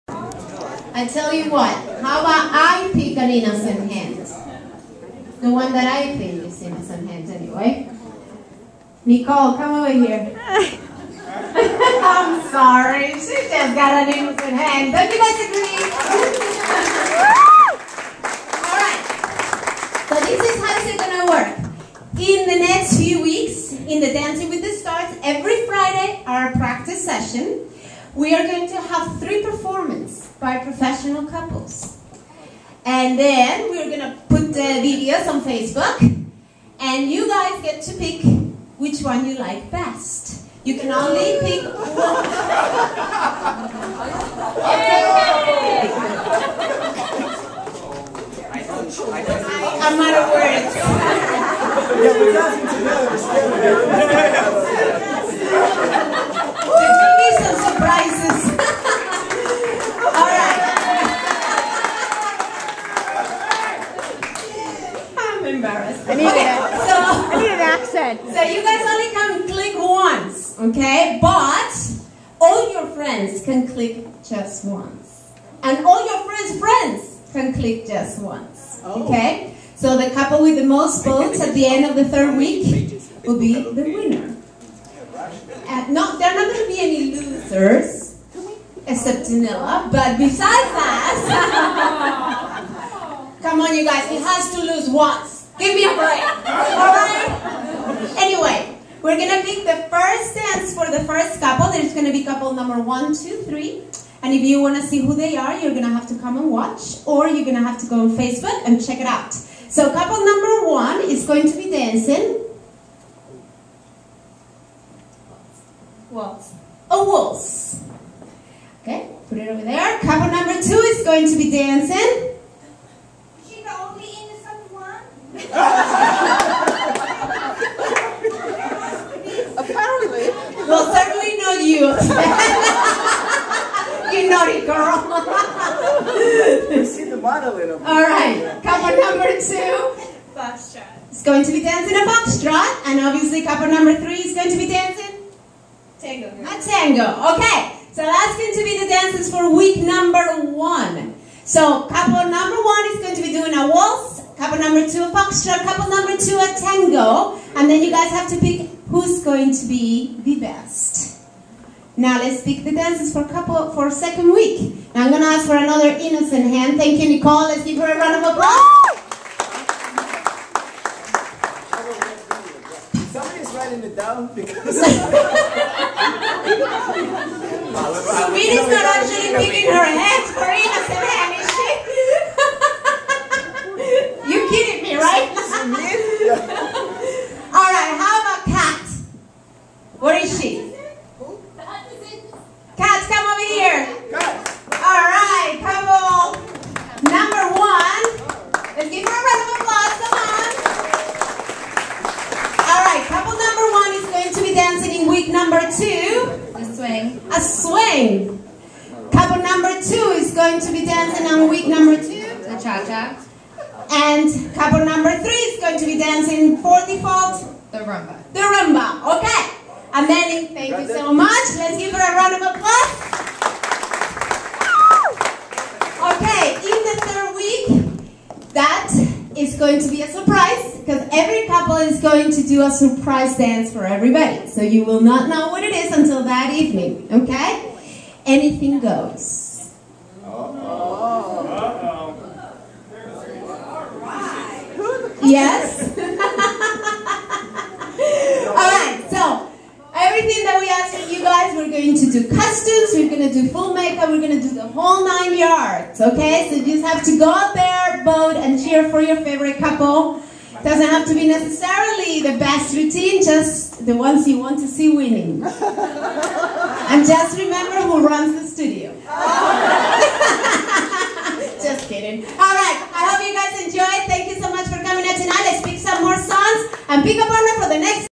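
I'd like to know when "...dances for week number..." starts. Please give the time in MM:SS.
02:28.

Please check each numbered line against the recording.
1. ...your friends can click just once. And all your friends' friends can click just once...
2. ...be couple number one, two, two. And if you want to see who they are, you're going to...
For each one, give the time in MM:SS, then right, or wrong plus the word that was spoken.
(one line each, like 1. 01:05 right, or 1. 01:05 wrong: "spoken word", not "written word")
1. 01:12 right
2. 01:42 wrong: "three", not "two".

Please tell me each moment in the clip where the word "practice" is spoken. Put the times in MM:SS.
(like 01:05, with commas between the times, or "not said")
00:26.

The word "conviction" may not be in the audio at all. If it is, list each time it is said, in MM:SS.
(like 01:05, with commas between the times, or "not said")
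not said.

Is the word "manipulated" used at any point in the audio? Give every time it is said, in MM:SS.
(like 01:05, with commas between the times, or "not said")
not said.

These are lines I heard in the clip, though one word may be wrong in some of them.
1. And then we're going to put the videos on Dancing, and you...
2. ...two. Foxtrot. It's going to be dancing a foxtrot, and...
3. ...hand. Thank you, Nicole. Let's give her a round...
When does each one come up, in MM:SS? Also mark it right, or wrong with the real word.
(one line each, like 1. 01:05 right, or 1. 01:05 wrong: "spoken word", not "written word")
1. 00:32 wrong: "Facebook", not "Dancing"
2. 02:19 right
3. 02:46 right.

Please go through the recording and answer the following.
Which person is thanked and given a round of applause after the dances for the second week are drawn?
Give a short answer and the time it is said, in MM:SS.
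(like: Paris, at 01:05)
Amelie, at 03:39.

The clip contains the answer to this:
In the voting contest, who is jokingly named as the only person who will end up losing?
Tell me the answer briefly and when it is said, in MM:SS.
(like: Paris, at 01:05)
Danila, at 01:29.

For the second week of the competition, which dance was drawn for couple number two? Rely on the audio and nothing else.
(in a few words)
Cha-cha.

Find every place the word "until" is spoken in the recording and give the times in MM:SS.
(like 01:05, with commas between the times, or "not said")
03:55.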